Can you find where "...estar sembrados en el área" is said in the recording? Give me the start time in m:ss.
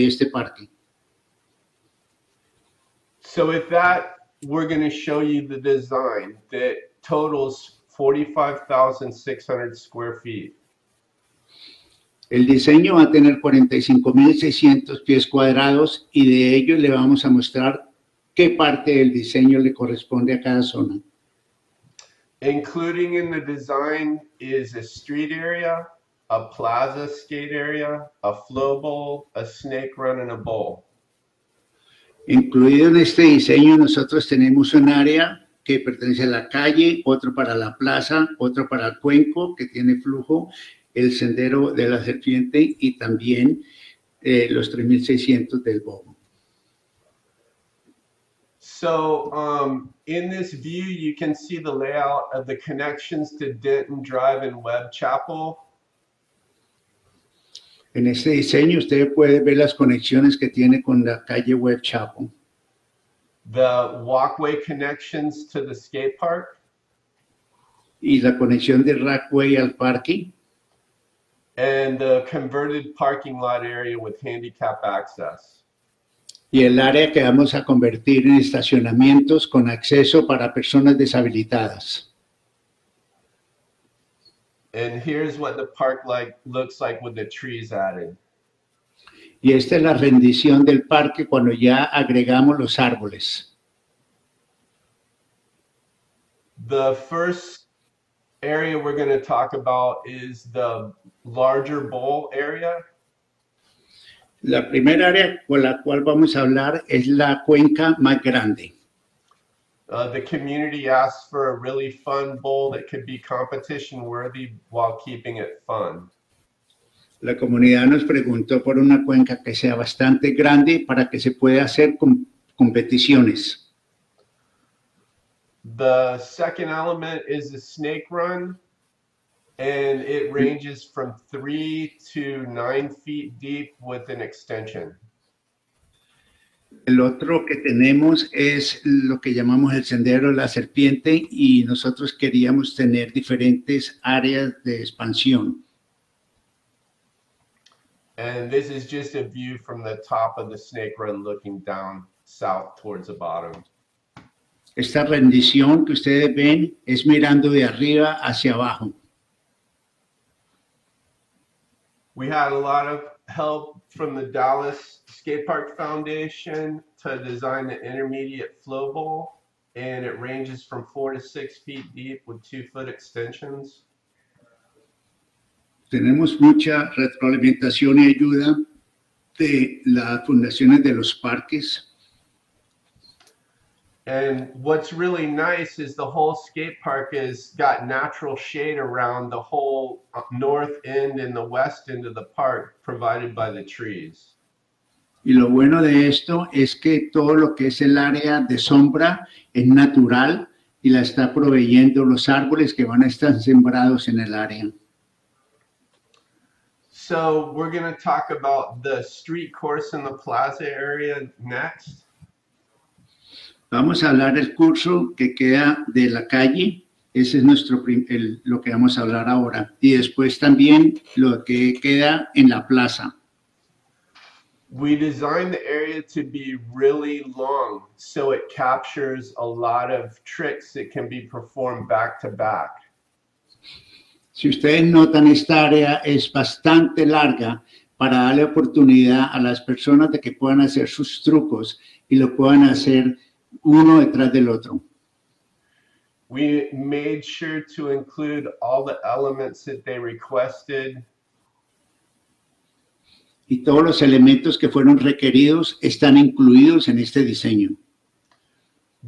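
3:23.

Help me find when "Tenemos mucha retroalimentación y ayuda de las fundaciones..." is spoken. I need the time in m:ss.
2:55.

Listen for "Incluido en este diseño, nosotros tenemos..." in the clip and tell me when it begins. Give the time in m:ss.
0:32.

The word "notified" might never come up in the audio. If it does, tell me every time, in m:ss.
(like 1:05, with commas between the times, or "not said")
not said.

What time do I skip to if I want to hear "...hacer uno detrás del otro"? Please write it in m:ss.
4:02.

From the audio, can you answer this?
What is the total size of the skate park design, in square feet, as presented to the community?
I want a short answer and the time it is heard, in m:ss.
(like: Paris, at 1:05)
45,600 square feet, at 0:07.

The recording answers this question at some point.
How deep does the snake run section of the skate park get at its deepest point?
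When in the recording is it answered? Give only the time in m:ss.
2:12.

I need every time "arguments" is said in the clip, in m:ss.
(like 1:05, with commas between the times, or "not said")
not said.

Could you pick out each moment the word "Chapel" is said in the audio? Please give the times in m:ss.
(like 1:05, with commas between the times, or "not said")
0:54, 1:01.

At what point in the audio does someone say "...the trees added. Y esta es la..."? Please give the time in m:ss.
1:27.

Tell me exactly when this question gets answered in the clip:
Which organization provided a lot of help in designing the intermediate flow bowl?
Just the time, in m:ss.
2:44.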